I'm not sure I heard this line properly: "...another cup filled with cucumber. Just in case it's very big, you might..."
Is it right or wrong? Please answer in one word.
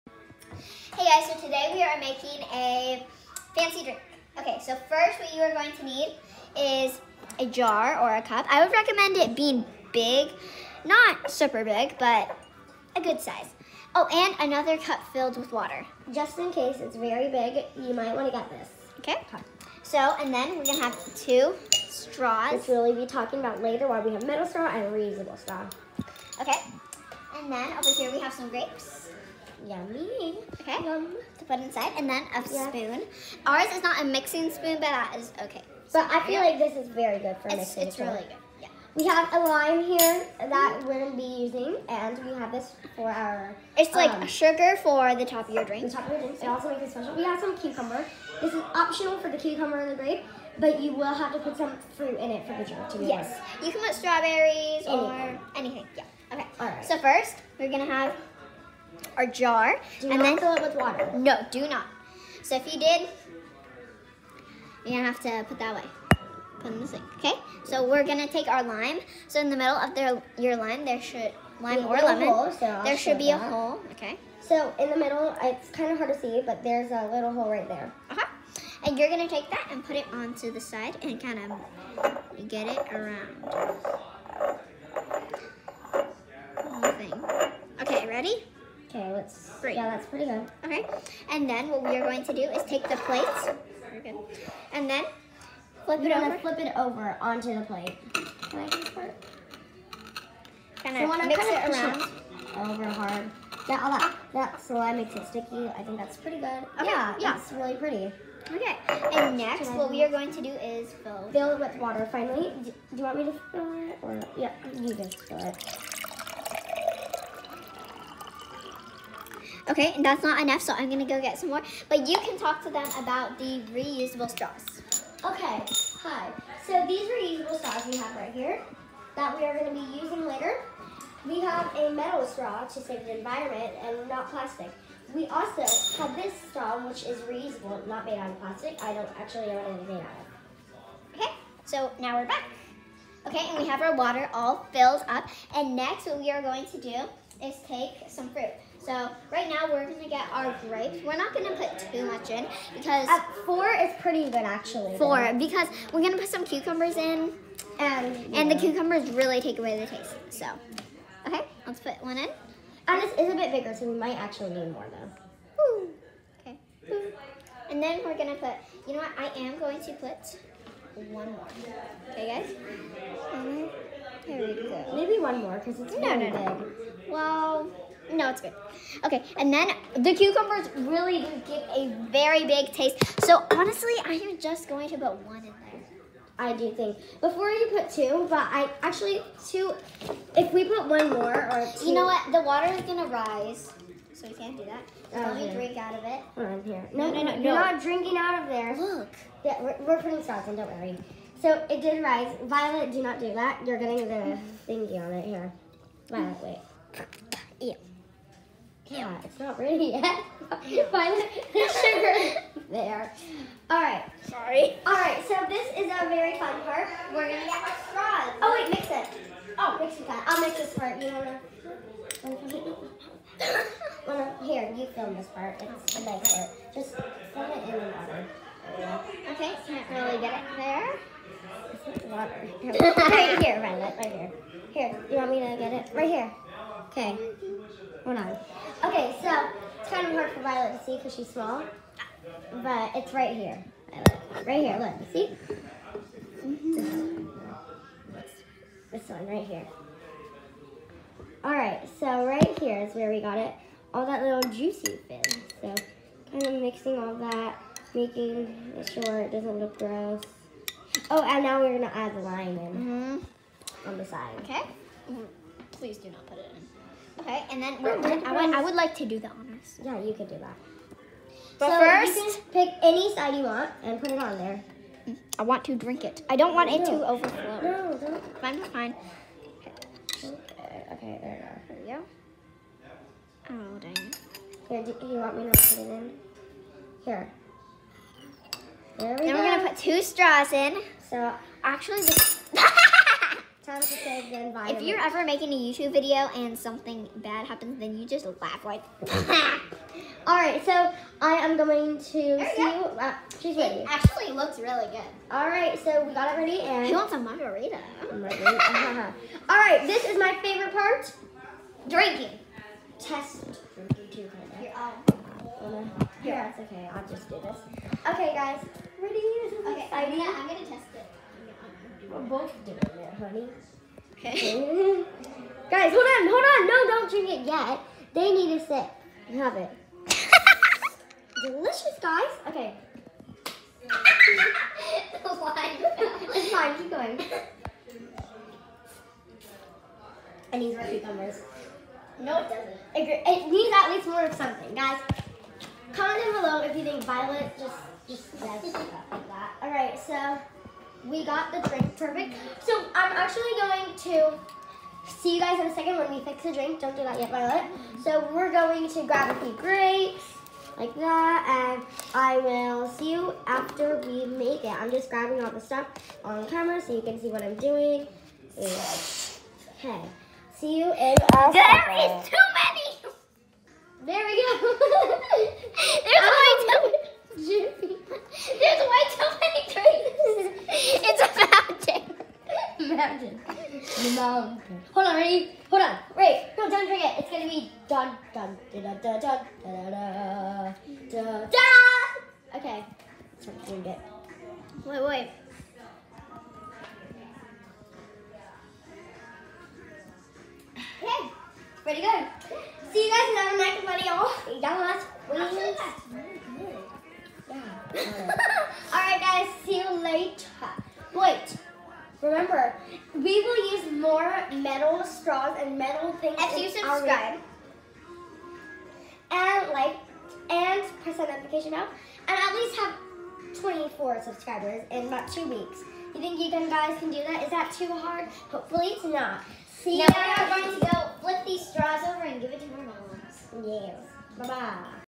wrong.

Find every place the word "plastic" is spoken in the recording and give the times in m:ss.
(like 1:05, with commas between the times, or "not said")
2:14, 2:18.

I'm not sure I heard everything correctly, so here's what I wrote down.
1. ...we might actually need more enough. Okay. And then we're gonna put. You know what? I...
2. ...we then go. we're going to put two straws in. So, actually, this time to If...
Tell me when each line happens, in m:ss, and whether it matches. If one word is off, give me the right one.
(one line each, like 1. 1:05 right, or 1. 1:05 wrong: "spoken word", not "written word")
1. 2:43 wrong: "though", not "enough"
2. 4:49 right.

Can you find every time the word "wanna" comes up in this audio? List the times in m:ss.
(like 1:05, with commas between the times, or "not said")
3:44.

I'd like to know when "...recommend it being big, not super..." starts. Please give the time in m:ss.
0:08.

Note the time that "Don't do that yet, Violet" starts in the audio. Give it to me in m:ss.
5:56.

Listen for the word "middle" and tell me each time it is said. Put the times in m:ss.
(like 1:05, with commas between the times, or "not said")
1:09, 1:14.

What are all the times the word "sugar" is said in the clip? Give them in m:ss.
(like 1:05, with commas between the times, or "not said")
0:44, 3:31.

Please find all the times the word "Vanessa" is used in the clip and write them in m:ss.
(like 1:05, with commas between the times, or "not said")
not said.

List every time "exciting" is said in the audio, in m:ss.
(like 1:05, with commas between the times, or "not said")
not said.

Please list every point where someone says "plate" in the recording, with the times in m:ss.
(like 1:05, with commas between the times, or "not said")
1:32, 1:37.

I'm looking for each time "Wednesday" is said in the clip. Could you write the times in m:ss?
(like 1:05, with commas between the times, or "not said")
not said.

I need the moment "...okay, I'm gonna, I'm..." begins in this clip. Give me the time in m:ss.
5:19.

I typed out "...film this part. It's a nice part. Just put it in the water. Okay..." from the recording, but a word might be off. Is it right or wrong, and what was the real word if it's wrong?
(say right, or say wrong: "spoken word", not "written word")
right.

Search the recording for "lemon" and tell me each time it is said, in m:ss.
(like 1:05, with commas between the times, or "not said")
1:11.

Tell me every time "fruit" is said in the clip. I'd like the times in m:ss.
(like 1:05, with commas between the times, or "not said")
0:51, 2:28.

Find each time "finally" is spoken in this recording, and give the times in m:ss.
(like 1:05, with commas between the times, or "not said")
1:52.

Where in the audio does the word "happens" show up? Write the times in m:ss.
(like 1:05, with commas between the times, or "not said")
4:57, 6:23.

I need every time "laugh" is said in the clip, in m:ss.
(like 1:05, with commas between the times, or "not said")
4:58.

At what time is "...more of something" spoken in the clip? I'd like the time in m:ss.
5:44.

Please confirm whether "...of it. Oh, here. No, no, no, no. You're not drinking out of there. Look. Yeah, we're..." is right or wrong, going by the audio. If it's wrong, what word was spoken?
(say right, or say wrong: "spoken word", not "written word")
right.